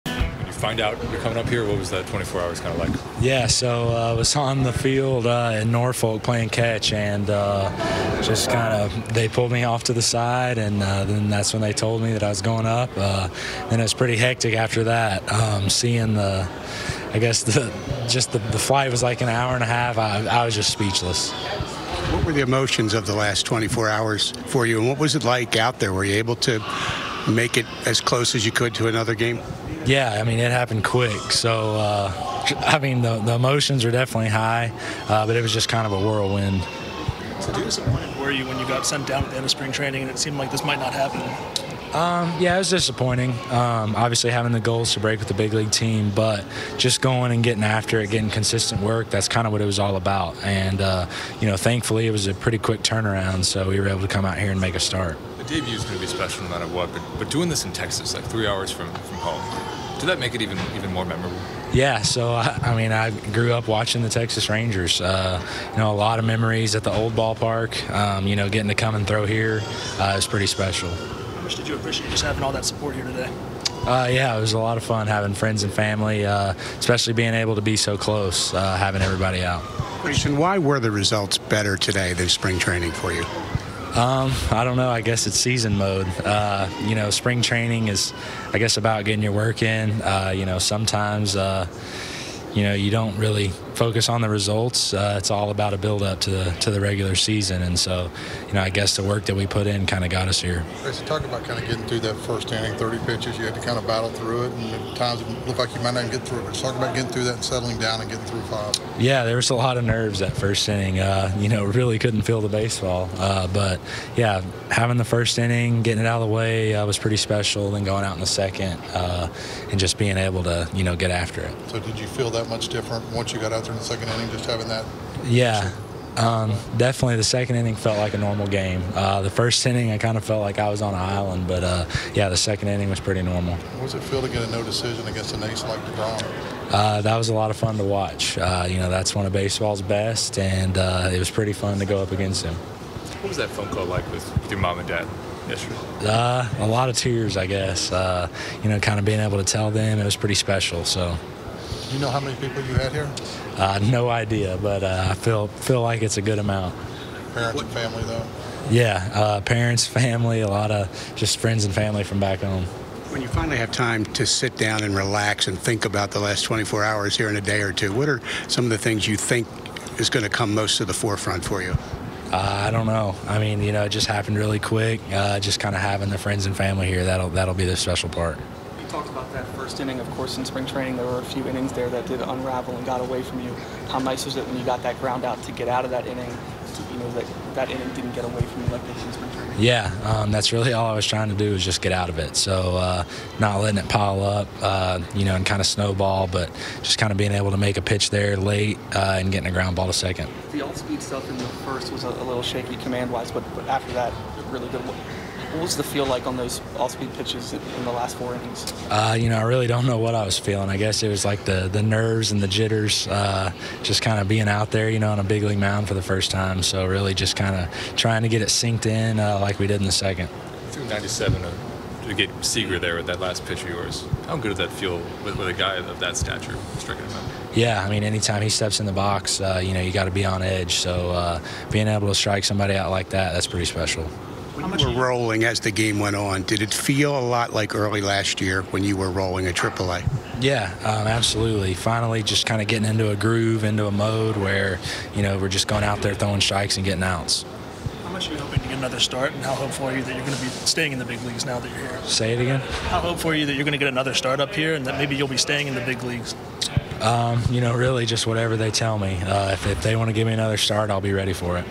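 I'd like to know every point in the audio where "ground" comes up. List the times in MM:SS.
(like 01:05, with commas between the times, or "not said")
03:04, 03:19.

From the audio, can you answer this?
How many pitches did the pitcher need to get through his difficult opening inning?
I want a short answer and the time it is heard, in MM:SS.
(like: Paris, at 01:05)
30, at 01:42.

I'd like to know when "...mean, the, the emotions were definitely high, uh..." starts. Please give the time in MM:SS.
00:32.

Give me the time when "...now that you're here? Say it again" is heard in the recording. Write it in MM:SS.
04:11.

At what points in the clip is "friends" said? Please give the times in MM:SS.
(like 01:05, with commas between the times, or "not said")
01:15, 02:41, 02:56.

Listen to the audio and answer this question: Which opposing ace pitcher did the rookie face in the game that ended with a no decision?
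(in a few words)
DeGrom.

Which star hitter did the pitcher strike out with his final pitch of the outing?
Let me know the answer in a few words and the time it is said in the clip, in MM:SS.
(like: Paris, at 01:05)
Seager, at 03:42.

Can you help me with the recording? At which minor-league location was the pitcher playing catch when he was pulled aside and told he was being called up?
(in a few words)
Norfolk.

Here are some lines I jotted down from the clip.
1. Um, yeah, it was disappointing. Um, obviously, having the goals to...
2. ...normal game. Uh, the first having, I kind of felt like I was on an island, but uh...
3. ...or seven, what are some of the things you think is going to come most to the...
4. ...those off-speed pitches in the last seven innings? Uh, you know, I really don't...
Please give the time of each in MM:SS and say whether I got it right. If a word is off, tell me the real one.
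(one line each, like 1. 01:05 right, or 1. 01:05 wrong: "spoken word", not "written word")
1. 00:41 right
2. 02:08 wrong: "inning", not "having"
3. 02:47 wrong: "two", not "seven"
4. 03:26 wrong: "four", not "seven".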